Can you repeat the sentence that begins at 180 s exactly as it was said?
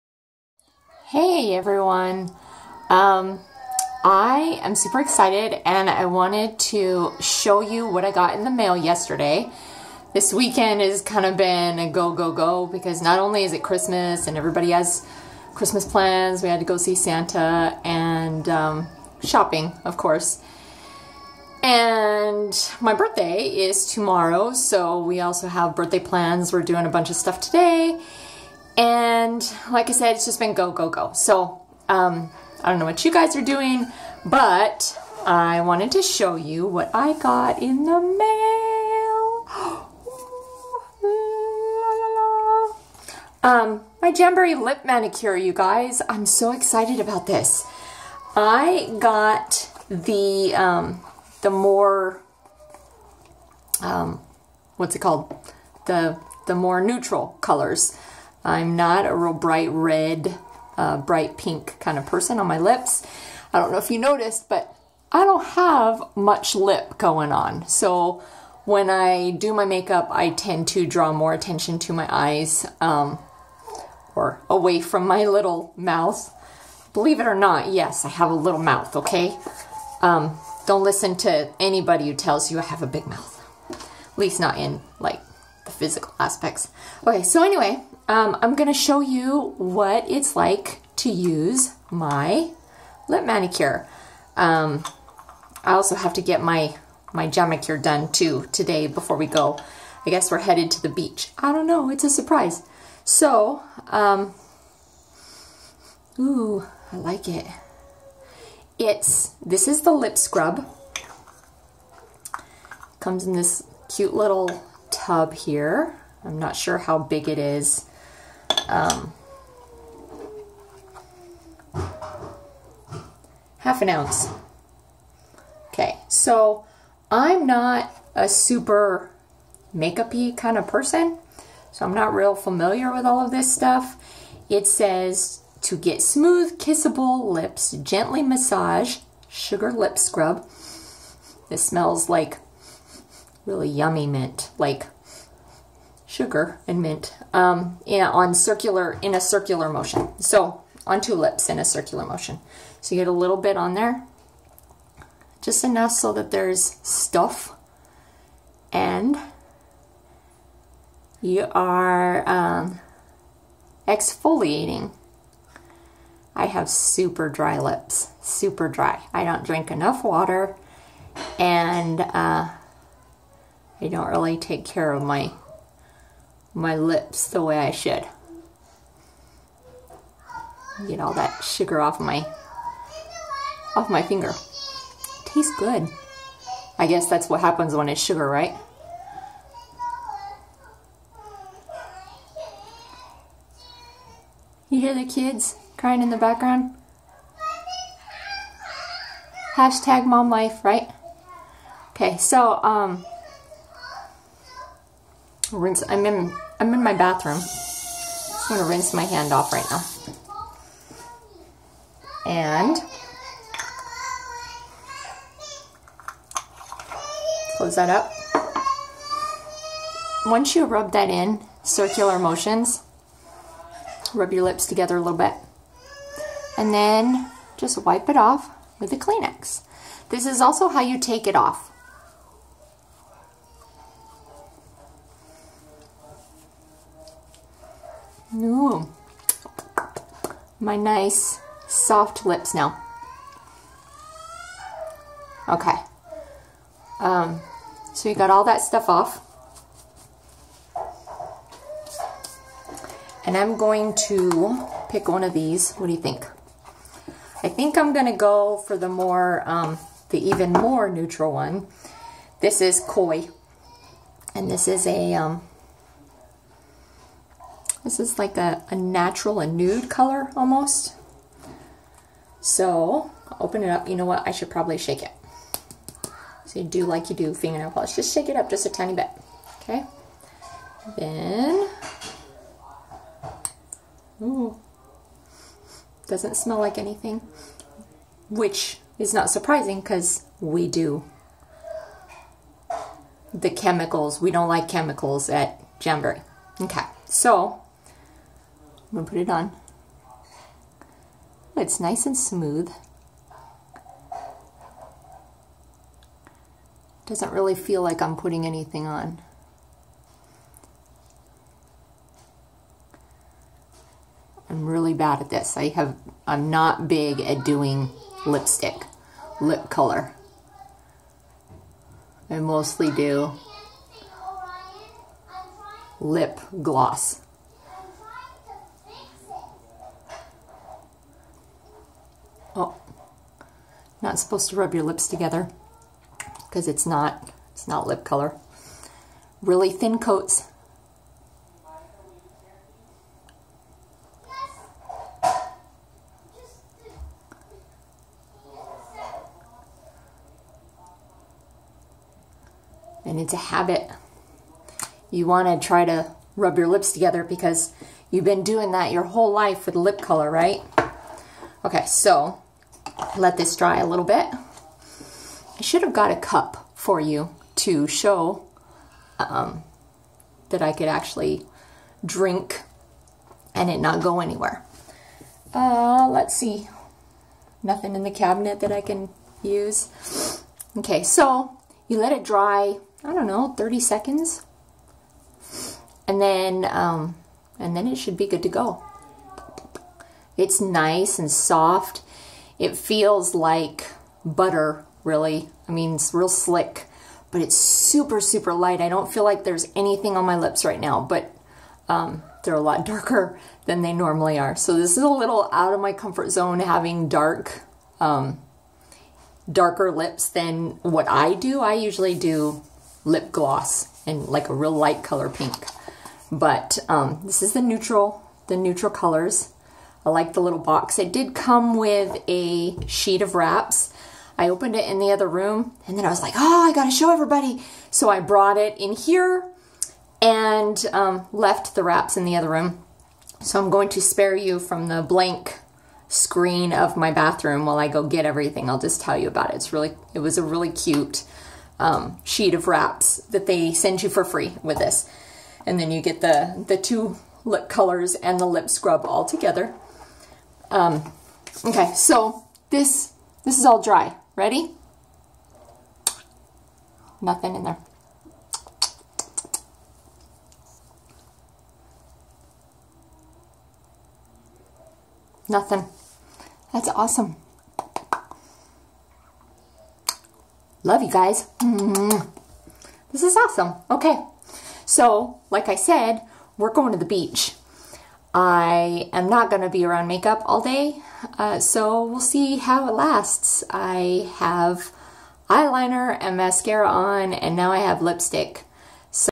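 Get all that sugar off my off my finger.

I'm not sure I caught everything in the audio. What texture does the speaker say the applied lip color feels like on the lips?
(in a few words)
butter.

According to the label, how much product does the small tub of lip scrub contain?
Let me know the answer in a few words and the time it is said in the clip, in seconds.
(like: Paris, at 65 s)
half an ounce, at 123 s.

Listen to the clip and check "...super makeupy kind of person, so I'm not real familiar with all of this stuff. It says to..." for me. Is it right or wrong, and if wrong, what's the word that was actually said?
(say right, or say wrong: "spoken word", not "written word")
right.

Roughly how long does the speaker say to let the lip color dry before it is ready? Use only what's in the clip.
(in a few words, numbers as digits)
30 seconds.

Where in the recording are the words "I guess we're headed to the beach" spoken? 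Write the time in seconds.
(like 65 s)
100 s.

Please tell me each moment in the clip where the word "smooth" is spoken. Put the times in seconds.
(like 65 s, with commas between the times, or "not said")
136 s, 302 s.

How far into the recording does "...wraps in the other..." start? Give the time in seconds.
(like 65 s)
431 s.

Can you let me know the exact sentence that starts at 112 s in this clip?
Comes in this cute little tub here.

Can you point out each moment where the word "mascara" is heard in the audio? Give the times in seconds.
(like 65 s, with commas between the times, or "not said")
486 s.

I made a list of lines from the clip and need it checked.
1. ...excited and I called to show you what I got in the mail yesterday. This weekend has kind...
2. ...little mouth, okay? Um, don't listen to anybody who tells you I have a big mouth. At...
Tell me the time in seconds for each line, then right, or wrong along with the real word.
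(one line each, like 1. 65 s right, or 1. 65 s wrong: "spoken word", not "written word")
1. 5 s wrong: "wanted", not "called"
2. 78 s right.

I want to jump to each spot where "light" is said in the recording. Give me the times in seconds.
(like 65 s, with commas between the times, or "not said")
398 s, 414 s.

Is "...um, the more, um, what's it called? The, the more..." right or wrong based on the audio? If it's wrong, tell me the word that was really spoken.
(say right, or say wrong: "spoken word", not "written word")
right.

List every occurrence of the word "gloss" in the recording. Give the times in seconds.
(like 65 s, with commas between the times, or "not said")
326 s, 413 s.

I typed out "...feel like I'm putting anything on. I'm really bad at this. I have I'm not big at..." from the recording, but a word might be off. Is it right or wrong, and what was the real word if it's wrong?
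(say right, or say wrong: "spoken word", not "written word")
right.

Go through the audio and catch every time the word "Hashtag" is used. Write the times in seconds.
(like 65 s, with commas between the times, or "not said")
199 s.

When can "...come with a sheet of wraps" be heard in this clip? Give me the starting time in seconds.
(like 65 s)
421 s.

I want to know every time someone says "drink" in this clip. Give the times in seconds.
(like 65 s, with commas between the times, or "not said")
169 s, 372 s.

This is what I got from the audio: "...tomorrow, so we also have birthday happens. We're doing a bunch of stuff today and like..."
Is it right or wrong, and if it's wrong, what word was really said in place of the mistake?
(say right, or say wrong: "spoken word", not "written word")
wrong: "plans", not "happens".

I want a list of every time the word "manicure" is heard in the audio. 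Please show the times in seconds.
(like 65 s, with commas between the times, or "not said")
44 s, 93 s, 97 s.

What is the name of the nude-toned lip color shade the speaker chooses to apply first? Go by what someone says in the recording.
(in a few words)
Koi.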